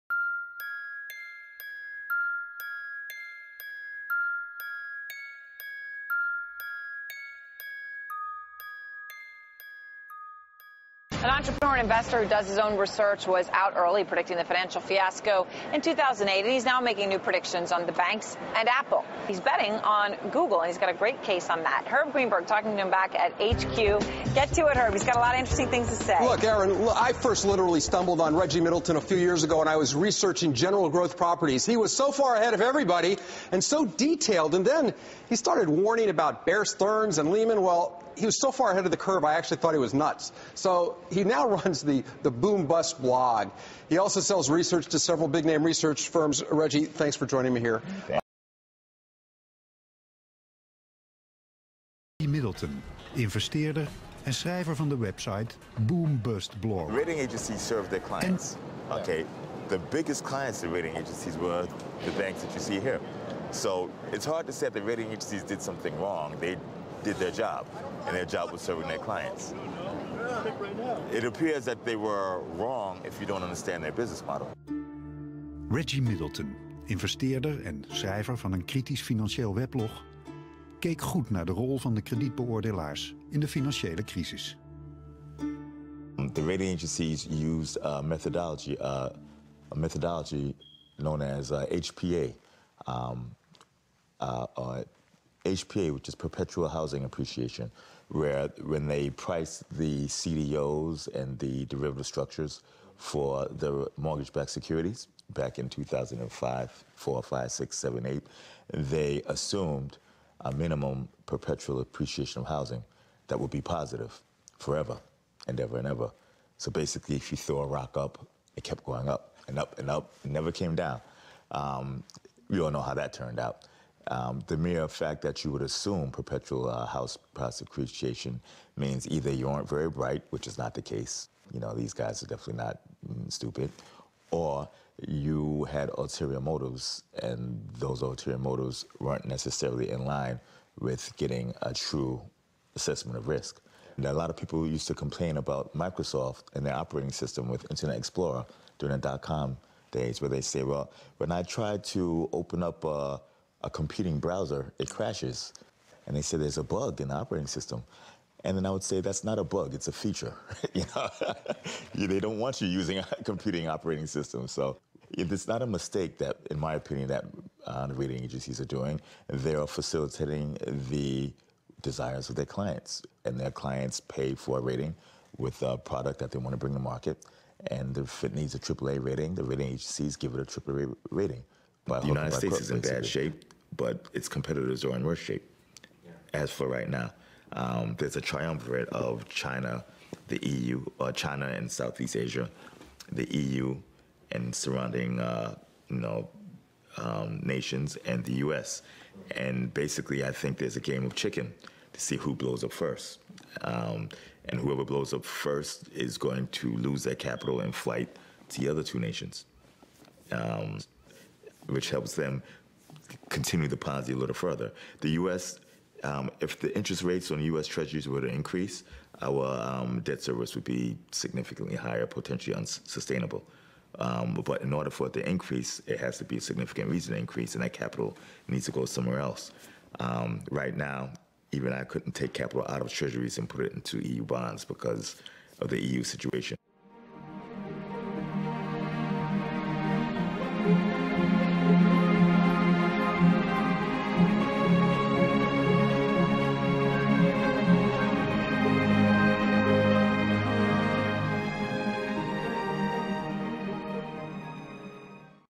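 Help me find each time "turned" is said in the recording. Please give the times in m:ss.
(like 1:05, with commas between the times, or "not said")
2:03.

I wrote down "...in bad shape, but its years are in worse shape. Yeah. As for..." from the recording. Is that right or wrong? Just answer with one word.
wrong.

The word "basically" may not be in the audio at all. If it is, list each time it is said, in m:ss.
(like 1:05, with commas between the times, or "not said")
1:56, 3:19.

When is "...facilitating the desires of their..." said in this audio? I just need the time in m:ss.
2:49.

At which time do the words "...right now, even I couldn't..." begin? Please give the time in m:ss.
3:50.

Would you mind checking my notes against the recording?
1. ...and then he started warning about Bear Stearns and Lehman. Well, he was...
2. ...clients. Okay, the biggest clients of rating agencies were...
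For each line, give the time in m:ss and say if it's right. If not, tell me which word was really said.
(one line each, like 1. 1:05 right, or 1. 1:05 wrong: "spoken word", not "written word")
1. 0:34 right
2. 0:57 right.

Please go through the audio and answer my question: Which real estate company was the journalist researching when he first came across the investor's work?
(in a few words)
General Growth Properties.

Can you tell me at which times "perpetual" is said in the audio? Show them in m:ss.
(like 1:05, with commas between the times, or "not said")
1:36, 1:51, 2:06.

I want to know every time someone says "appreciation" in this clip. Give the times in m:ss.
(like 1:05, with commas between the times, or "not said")
1:37, 1:51, 2:07.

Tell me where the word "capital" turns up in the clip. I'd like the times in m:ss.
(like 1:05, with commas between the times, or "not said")
3:27, 3:47, 3:52.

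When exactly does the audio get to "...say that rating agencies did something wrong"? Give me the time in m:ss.
1:04.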